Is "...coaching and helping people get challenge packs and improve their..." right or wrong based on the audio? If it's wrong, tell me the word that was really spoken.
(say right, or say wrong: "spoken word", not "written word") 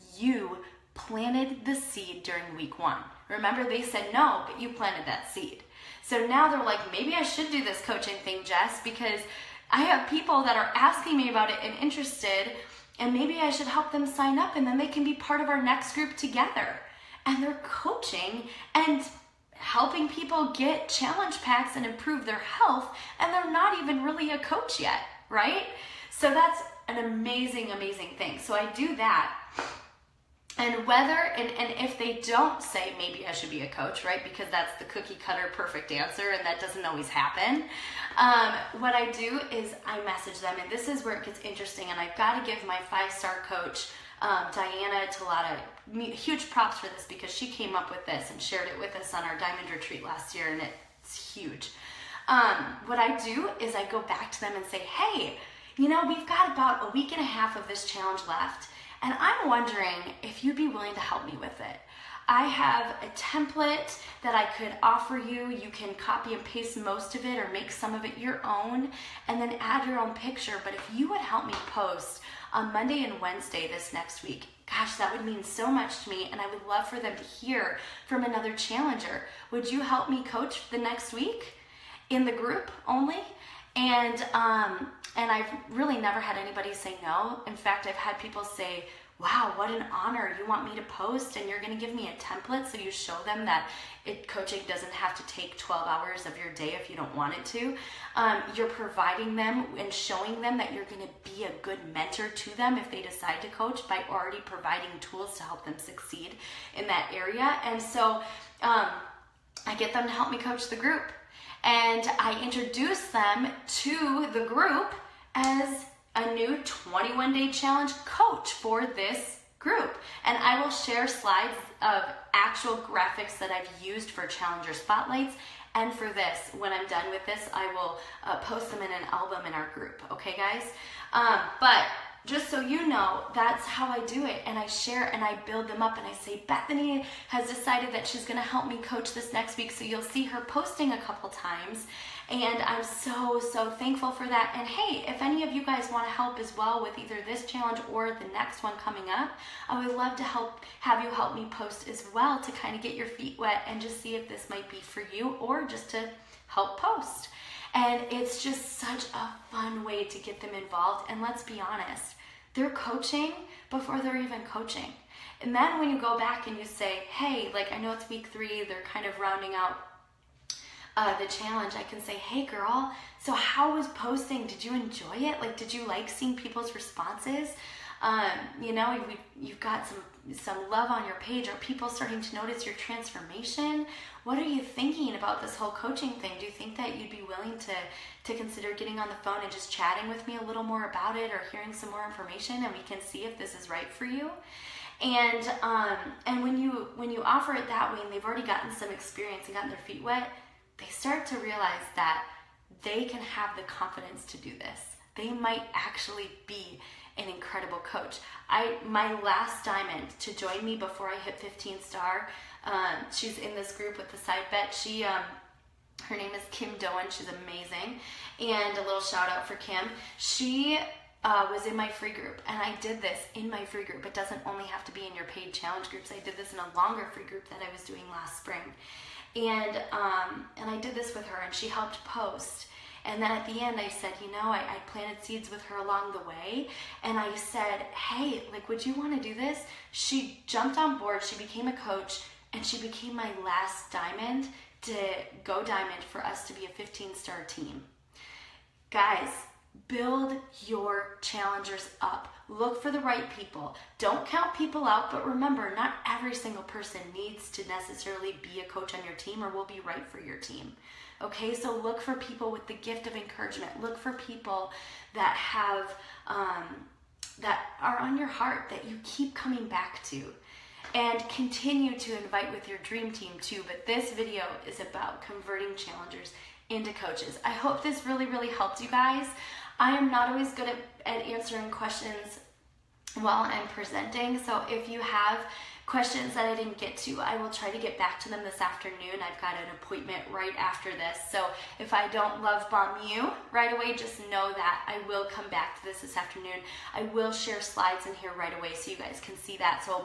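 right.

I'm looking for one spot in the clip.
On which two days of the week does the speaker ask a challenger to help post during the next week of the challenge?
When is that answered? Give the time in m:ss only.
1:12.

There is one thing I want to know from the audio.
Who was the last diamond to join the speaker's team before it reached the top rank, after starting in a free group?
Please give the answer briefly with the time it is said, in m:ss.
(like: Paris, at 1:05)
Kim Doan, at 3:36.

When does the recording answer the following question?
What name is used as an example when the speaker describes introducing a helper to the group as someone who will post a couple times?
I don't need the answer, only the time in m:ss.
2:16.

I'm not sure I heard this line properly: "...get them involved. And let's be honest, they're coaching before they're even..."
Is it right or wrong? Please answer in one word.
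right.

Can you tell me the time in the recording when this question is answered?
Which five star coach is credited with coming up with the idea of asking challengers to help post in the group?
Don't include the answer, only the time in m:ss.
0:44.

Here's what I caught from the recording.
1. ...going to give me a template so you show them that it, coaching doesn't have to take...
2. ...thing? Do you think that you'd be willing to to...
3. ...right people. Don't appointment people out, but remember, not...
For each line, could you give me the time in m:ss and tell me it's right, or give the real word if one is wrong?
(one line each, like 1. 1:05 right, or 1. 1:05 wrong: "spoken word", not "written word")
1. 1:31 right
2. 3:06 right
3. 4:12 wrong: "count", not "appointment".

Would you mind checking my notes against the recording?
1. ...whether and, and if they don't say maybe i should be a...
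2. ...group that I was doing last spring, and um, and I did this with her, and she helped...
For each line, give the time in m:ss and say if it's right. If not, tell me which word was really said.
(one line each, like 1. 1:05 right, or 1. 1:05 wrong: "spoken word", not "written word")
1. 0:30 right
2. 3:47 right.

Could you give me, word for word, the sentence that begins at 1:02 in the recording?
I have a template that I could offer you.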